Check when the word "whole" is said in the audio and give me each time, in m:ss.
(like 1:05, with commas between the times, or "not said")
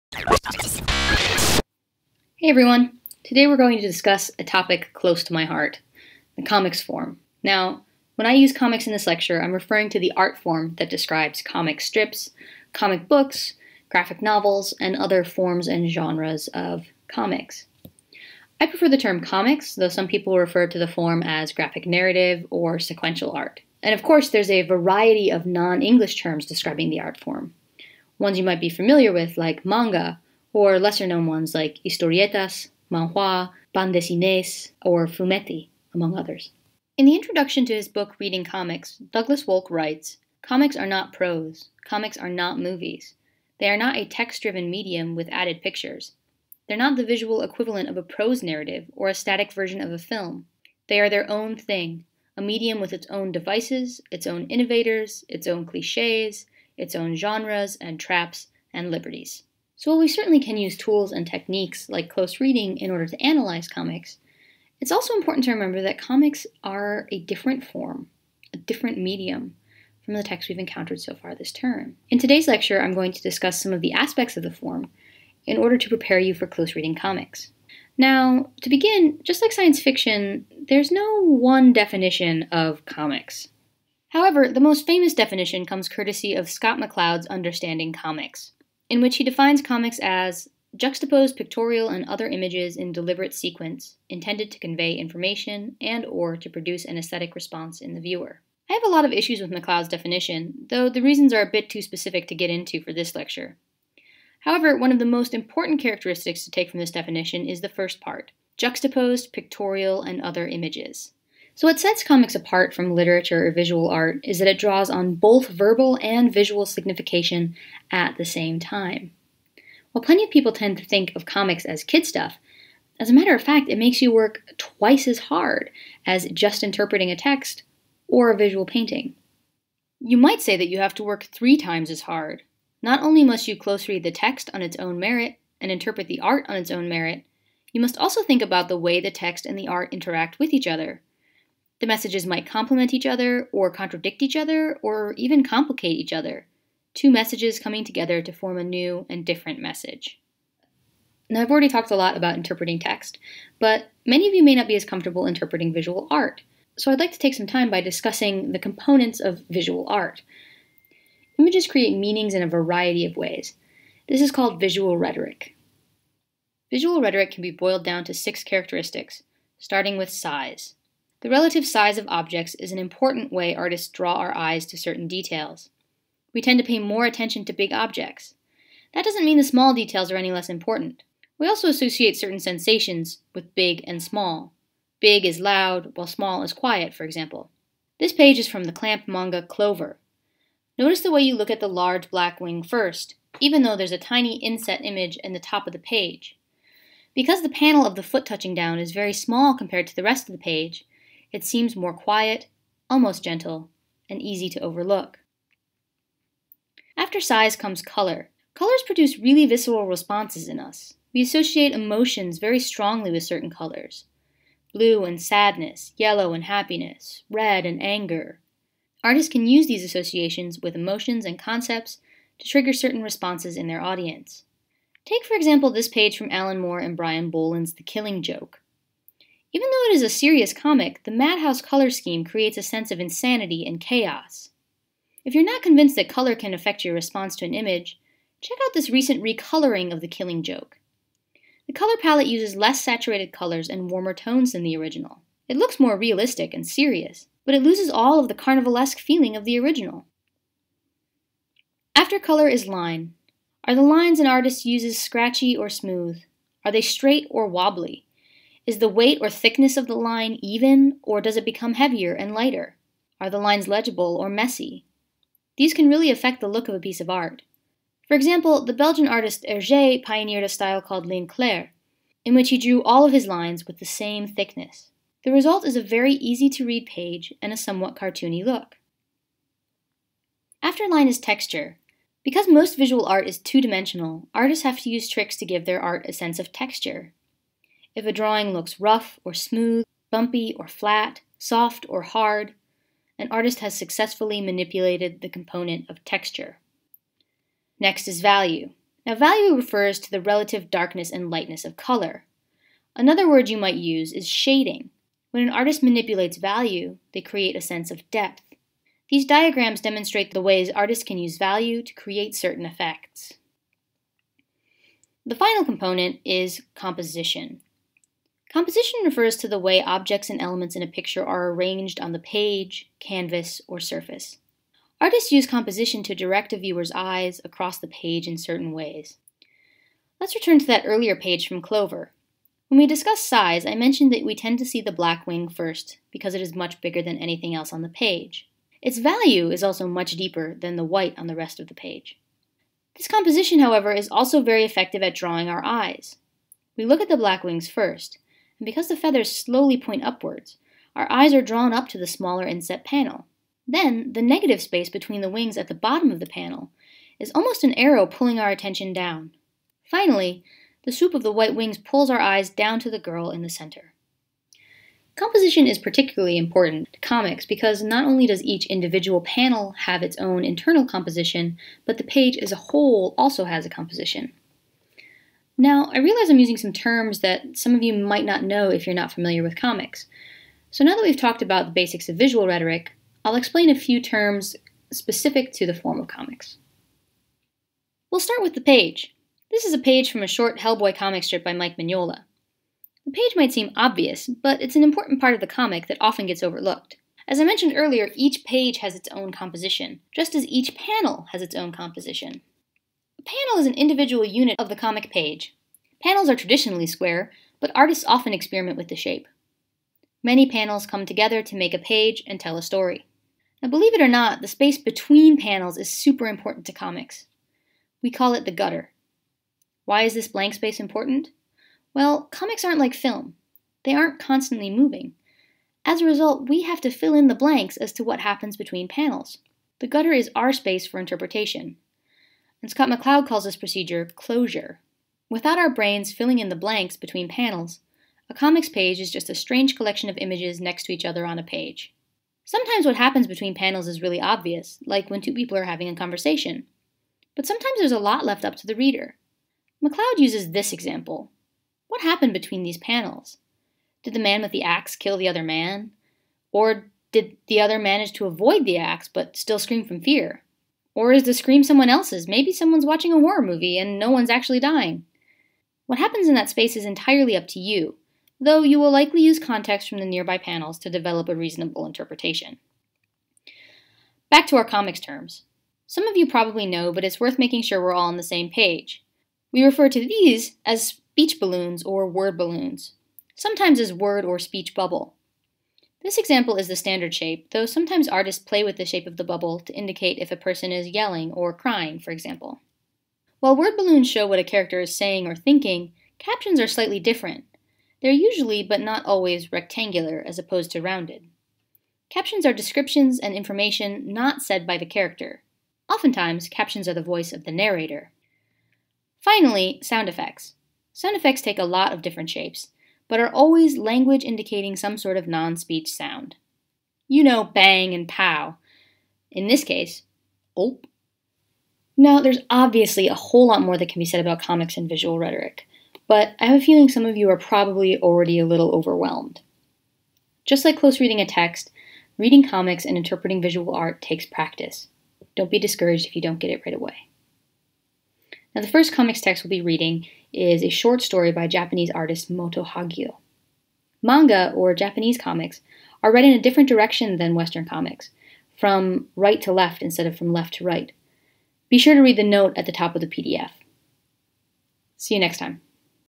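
6:12, 8:43.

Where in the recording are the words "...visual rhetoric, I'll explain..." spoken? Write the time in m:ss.
6:22.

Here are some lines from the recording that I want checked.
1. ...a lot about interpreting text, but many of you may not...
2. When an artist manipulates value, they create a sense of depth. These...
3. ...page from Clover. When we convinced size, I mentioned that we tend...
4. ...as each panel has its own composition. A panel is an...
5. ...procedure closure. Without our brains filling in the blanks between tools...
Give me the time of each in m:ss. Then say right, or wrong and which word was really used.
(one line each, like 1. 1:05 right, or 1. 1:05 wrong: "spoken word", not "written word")
1. 2:31 right
2. 5:05 right
3. 5:31 wrong: "discussed", not "convinced"
4. 6:40 right
5. 7:13 wrong: "panels", not "tools".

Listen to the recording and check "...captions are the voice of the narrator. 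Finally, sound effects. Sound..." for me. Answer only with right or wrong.
right.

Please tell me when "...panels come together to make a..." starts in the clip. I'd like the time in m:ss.
6:50.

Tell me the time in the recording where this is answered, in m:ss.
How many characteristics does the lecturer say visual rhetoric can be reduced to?
2:48.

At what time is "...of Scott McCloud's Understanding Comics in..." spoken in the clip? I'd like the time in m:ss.
1:26.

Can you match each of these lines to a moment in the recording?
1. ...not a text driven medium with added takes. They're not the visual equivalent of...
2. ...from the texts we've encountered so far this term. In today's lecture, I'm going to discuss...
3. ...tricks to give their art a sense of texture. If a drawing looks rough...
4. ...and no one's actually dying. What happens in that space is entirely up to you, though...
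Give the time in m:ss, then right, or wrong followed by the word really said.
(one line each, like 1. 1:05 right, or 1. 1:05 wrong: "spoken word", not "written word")
1. 0:43 wrong: "pictures", not "takes"
2. 1:10 right
3. 4:45 right
4. 7:43 right.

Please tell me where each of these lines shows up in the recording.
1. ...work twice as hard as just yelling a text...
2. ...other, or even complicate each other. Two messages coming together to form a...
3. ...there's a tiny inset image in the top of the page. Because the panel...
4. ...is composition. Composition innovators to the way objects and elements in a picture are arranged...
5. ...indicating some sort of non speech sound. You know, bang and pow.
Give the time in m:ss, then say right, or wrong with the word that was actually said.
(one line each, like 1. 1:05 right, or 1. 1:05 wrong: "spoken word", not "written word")
1. 2:04 wrong: "interpreting", not "yelling"
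2. 2:24 right
3. 3:13 right
4. 5:16 wrong: "refers", not "innovators"
5. 8:34 right.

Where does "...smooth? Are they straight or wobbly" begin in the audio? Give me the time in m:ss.
4:15.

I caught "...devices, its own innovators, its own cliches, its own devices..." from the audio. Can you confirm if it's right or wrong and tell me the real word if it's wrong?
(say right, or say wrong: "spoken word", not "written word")
wrong: "genres", not "devices".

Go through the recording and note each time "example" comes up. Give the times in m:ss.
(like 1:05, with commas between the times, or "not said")
3:07, 3:45, 4:28, 7:30, 8:06, 8:12.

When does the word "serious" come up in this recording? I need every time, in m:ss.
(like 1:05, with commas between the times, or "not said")
3:50, 4:06.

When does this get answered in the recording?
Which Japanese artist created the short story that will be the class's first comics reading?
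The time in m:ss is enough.
9:02.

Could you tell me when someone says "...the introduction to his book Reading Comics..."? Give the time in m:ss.
0:37.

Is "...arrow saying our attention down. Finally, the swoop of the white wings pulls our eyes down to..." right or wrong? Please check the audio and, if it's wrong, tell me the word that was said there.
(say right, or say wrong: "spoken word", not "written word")
wrong: "pulling", not "saying".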